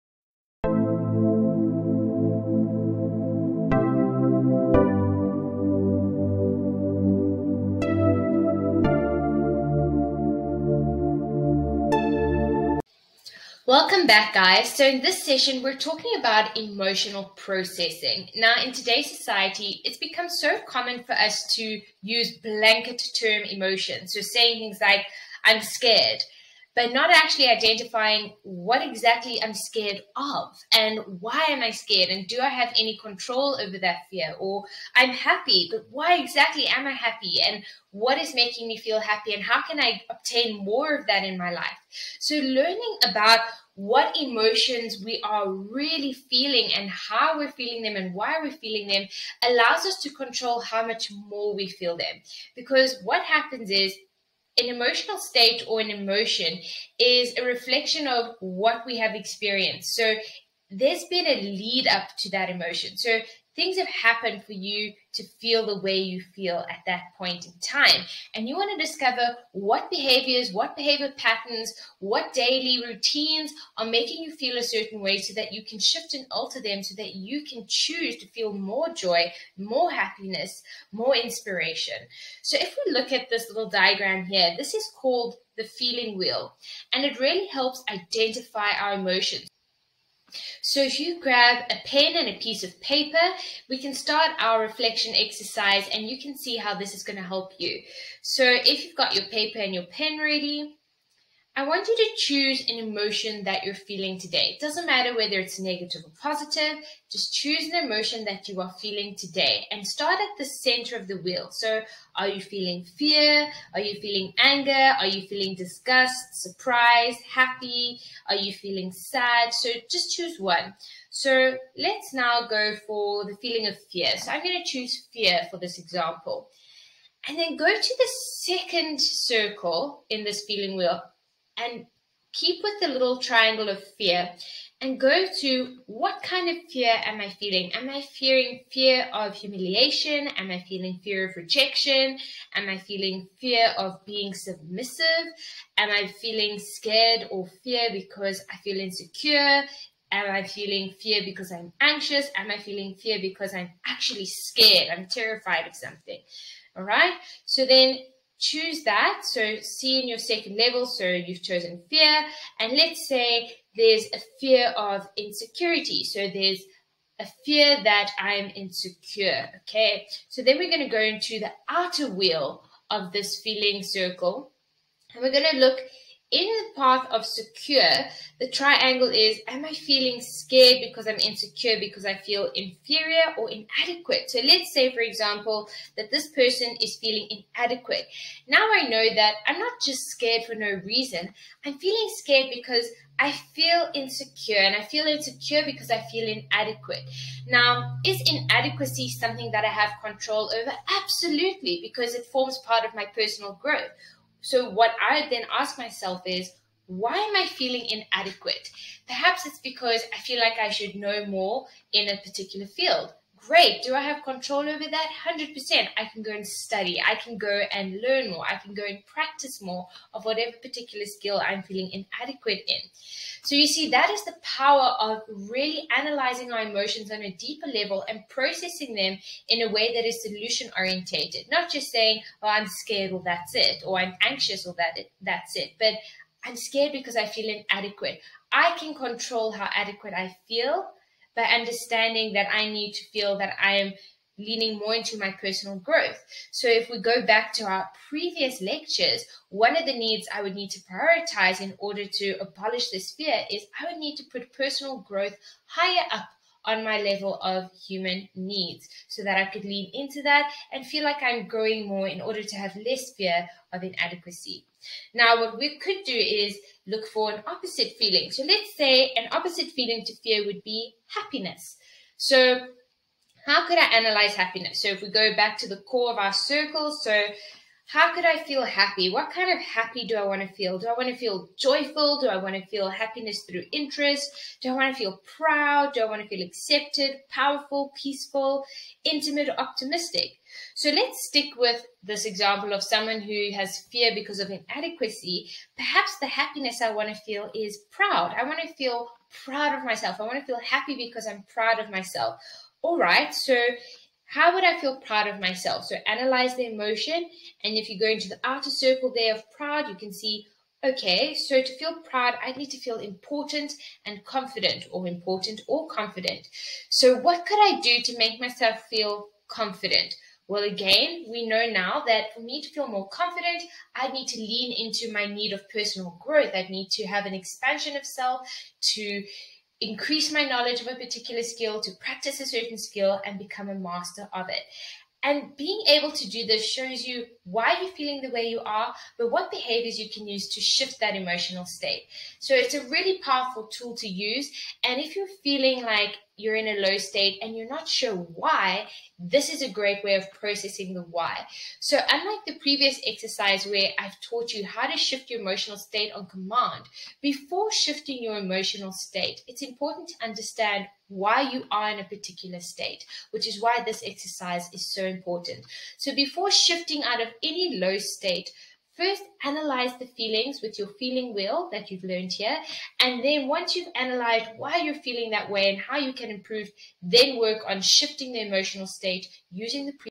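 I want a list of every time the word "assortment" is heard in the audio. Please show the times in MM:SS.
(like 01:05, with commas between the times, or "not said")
not said.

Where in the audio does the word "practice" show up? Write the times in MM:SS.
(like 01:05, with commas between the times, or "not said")
03:39, 05:31.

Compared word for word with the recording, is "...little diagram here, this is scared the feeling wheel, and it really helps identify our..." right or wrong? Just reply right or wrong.
wrong.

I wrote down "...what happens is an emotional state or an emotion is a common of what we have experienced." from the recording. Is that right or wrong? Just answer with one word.
wrong.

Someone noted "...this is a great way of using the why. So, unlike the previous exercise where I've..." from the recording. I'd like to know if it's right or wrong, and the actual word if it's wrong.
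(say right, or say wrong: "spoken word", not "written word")
wrong: "processing", not "using".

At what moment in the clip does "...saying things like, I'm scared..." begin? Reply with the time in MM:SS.
00:24.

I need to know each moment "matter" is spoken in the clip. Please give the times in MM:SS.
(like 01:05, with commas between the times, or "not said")
01:44.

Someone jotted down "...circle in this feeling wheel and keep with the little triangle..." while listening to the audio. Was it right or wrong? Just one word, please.
right.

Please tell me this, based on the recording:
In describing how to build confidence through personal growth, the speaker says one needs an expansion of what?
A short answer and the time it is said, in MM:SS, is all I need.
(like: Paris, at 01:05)
self, at 05:27.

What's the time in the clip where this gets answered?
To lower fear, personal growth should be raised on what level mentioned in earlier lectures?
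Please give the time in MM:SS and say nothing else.
04:17.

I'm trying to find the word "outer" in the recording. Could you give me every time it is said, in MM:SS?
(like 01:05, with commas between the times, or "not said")
02:51, 05:08.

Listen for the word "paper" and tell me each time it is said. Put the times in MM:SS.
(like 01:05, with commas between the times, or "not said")
01:32, 01:39.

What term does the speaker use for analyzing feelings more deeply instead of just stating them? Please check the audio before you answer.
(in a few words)
solution orientated.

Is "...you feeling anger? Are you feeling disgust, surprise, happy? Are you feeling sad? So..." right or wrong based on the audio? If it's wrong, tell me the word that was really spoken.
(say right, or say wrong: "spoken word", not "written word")
right.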